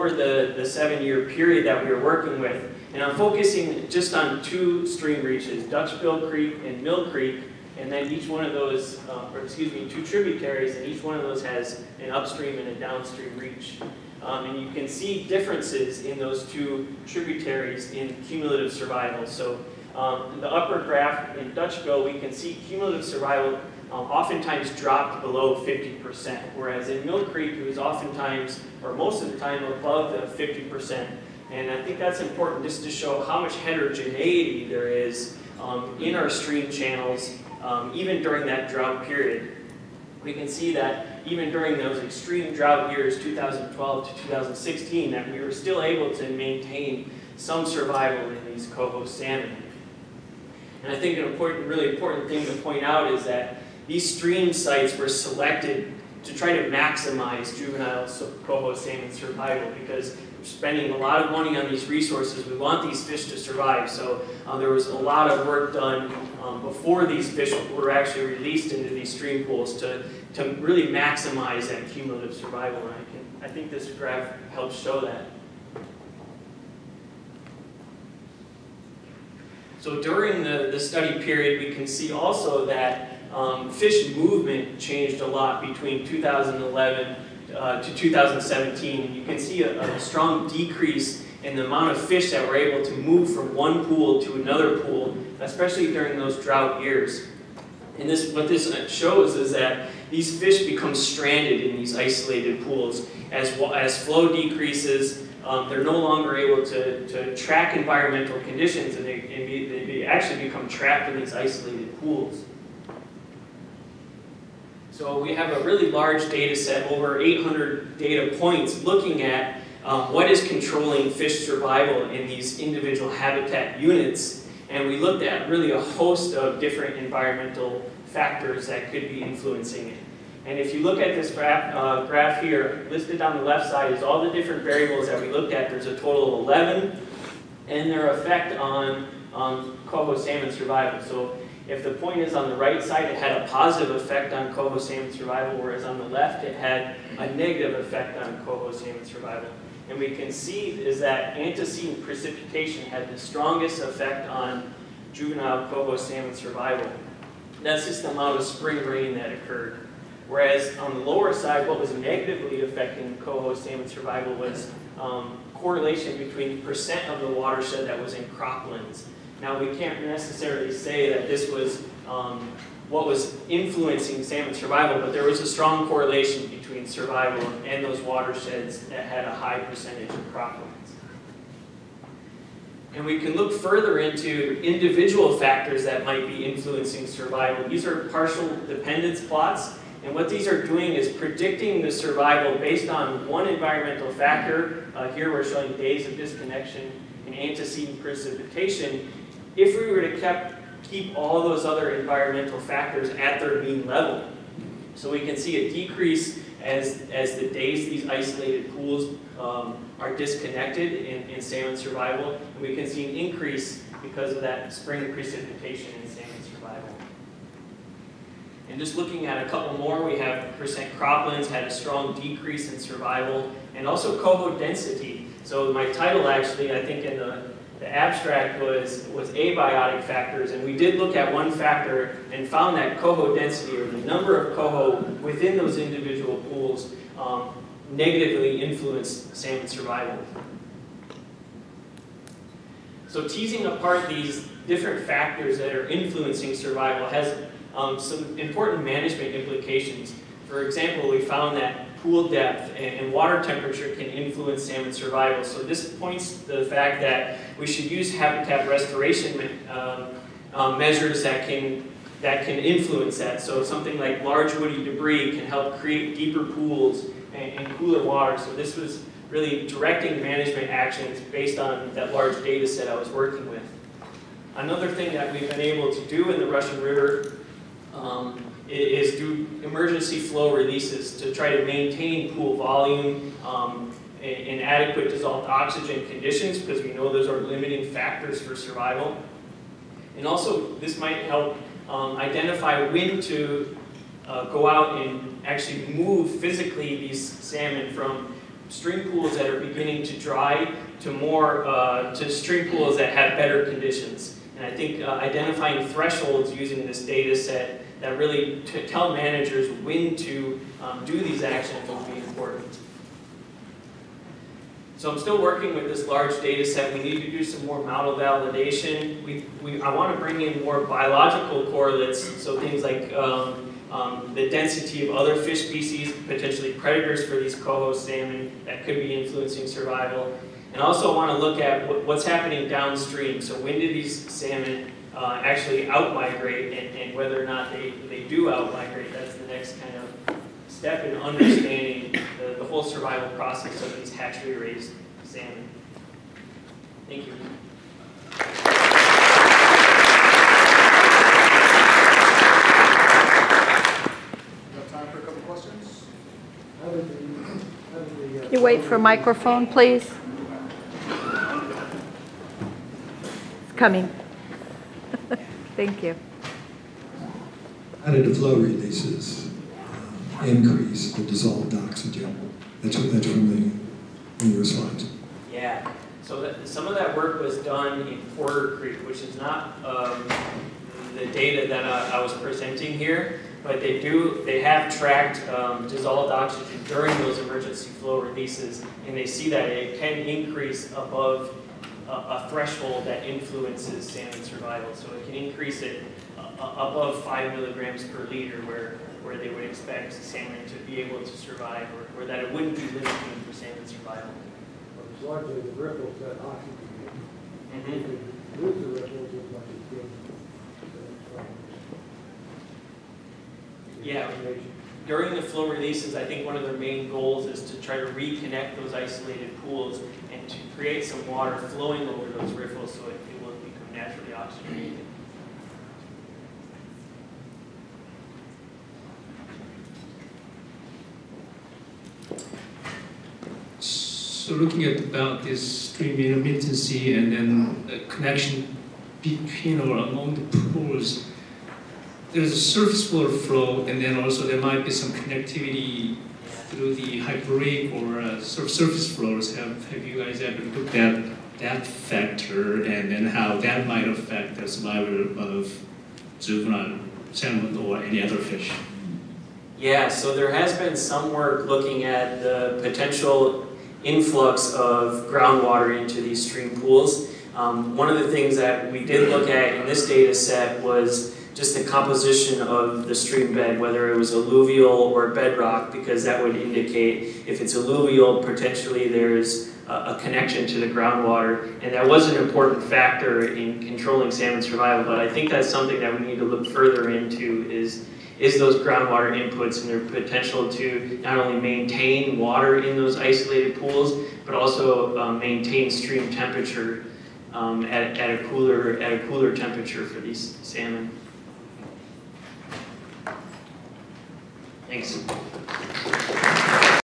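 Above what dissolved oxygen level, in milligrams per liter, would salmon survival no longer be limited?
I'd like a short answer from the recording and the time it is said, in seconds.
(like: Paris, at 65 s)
5 mg/L, at 397 s.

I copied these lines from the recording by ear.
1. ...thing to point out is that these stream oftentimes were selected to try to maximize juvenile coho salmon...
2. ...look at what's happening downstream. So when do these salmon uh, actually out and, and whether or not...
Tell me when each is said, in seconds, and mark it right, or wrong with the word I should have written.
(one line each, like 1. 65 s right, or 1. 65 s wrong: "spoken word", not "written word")
1. 52 s wrong: "sites", not "oftentimes"
2. 331 s right.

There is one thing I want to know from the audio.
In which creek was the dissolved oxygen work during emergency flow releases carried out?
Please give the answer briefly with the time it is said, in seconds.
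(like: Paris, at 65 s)
Porter Creek, at 378 s.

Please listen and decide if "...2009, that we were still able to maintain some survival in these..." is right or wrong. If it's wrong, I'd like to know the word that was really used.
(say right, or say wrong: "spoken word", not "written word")
wrong: "2016", not "2009".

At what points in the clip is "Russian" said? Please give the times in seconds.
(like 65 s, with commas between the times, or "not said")
276 s.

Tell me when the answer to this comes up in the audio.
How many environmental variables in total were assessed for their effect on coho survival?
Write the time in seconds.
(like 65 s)
136 s.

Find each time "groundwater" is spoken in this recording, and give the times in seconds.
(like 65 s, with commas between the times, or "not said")
465 s, 480 s, 488 s.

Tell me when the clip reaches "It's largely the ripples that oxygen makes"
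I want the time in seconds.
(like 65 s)
405 s.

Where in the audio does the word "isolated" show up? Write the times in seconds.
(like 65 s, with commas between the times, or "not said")
101 s, 111 s, 208 s, 418 s, 493 s.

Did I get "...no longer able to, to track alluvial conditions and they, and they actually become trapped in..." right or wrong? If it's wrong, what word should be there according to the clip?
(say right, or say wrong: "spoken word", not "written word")
wrong: "environmental", not "alluvial".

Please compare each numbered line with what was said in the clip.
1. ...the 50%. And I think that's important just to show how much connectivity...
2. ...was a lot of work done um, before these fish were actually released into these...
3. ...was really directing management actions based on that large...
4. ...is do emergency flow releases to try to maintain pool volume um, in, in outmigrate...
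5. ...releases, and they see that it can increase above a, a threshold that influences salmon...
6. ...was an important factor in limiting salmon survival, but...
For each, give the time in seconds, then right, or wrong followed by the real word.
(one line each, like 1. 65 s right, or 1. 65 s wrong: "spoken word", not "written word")
1. 30 s wrong: "heterogeneity", not "connectivity"
2. 64 s right
3. 268 s right
4. 278 s wrong: "adequate", not "outmigrate"
5. 388 s right
6. 482 s wrong: "controlling", not "limiting".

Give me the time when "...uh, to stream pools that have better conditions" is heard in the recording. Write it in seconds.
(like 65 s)
301 s.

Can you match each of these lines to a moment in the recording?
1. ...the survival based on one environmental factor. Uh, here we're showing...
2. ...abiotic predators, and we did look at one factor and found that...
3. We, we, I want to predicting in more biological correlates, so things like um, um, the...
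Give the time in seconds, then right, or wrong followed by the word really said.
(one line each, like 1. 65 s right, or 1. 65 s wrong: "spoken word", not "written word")
1. 191 s right
2. 229 s wrong: "factors", not "predators"
3. 319 s wrong: "bring", not "predicting".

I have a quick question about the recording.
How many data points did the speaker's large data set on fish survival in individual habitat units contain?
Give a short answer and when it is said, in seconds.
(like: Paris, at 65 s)
over 800, at 116 s.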